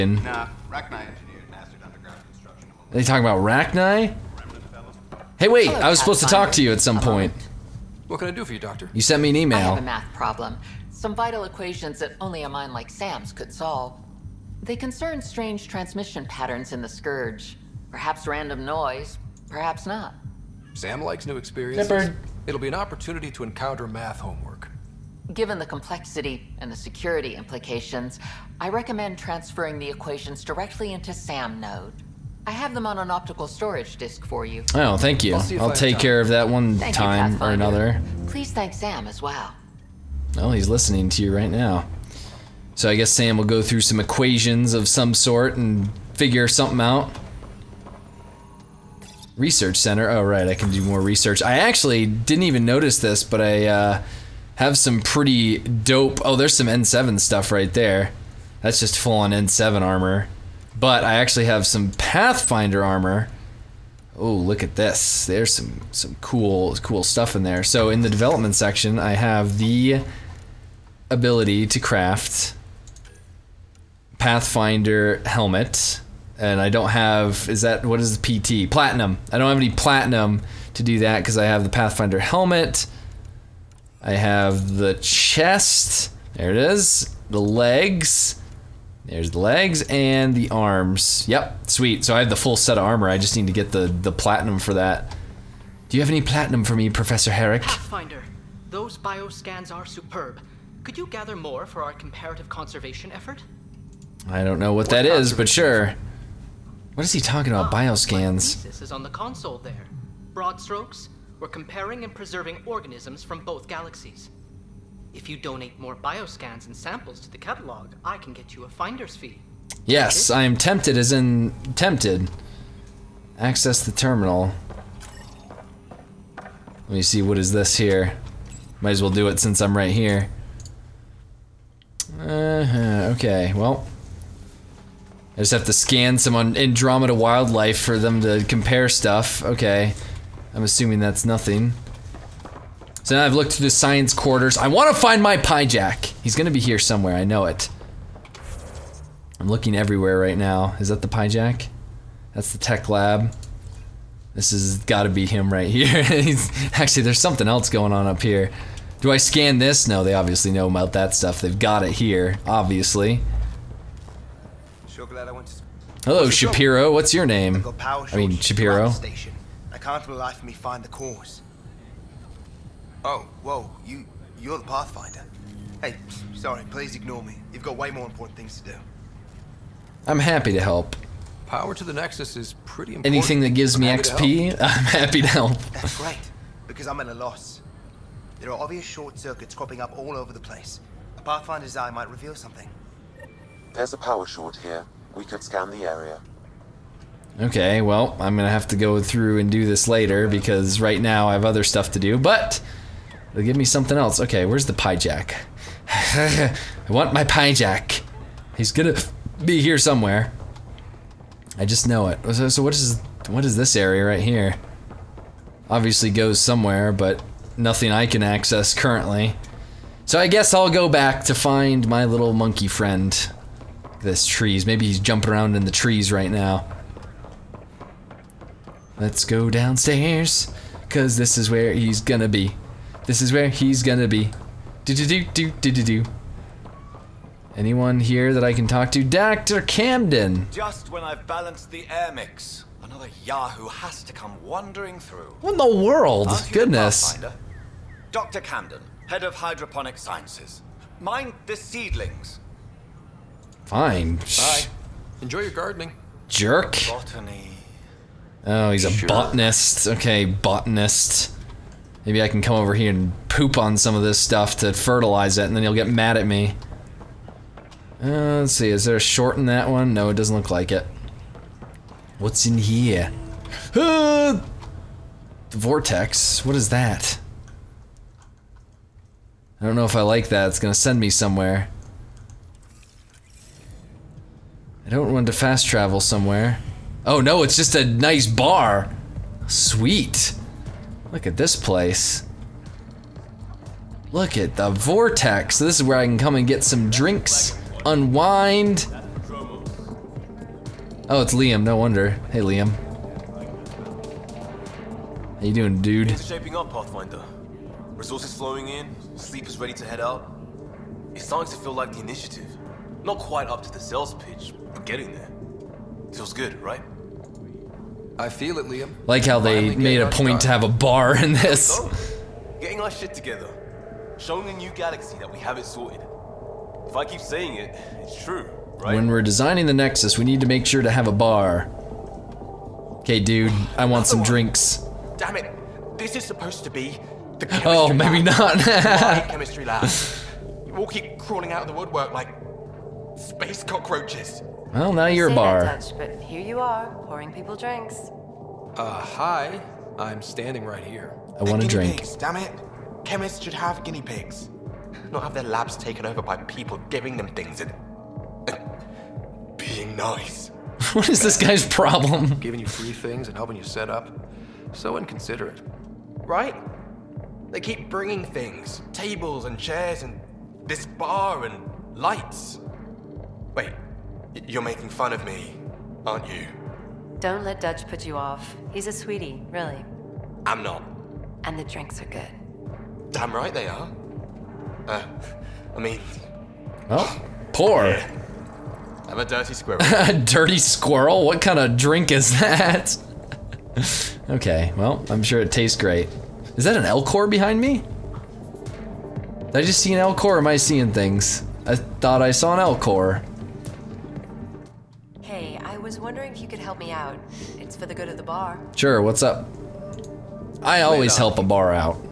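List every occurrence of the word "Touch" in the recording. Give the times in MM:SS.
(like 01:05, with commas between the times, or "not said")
05:45.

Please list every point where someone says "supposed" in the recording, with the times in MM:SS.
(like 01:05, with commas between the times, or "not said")
00:06, 05:36.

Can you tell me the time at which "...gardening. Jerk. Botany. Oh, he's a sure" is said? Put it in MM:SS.
04:15.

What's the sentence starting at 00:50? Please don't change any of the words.
Oh, right, I can do more research.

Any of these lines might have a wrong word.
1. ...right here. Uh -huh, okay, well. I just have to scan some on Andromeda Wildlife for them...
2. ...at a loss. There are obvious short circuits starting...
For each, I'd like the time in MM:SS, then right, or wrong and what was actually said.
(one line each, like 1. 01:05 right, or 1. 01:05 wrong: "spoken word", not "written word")
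1. 02:09 right
2. 03:07 wrong: "cropping", not "starting".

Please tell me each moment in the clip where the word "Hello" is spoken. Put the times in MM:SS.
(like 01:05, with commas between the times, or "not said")
00:05, 02:46.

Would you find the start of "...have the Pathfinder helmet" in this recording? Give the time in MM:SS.
01:21.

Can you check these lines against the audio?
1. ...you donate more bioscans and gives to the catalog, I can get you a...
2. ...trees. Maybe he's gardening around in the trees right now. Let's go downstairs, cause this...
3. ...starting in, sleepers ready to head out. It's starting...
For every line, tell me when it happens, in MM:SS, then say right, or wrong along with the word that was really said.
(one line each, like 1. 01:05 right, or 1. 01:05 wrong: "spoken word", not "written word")
1. 01:55 wrong: "samples", not "gives"
2. 03:44 wrong: "jumping", not "gardening"
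3. 05:08 wrong: "flowing", not "starting".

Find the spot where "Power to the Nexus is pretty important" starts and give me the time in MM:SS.
03:01.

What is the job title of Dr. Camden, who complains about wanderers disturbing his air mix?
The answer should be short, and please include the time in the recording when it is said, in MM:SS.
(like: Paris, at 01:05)
Head of hydroponic sciences, at 04:09.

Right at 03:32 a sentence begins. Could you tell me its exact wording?
So, so what is what is this area right here?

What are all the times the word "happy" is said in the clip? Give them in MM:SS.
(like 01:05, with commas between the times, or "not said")
03:00, 03:04.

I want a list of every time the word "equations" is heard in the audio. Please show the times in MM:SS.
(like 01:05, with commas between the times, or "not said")
00:11, 00:29, 00:44.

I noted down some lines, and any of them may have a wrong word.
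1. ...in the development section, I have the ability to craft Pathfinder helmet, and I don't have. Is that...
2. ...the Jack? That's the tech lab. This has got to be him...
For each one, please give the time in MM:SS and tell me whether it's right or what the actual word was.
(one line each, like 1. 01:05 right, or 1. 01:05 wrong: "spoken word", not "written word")
1. 01:07 right
2. 02:31 right.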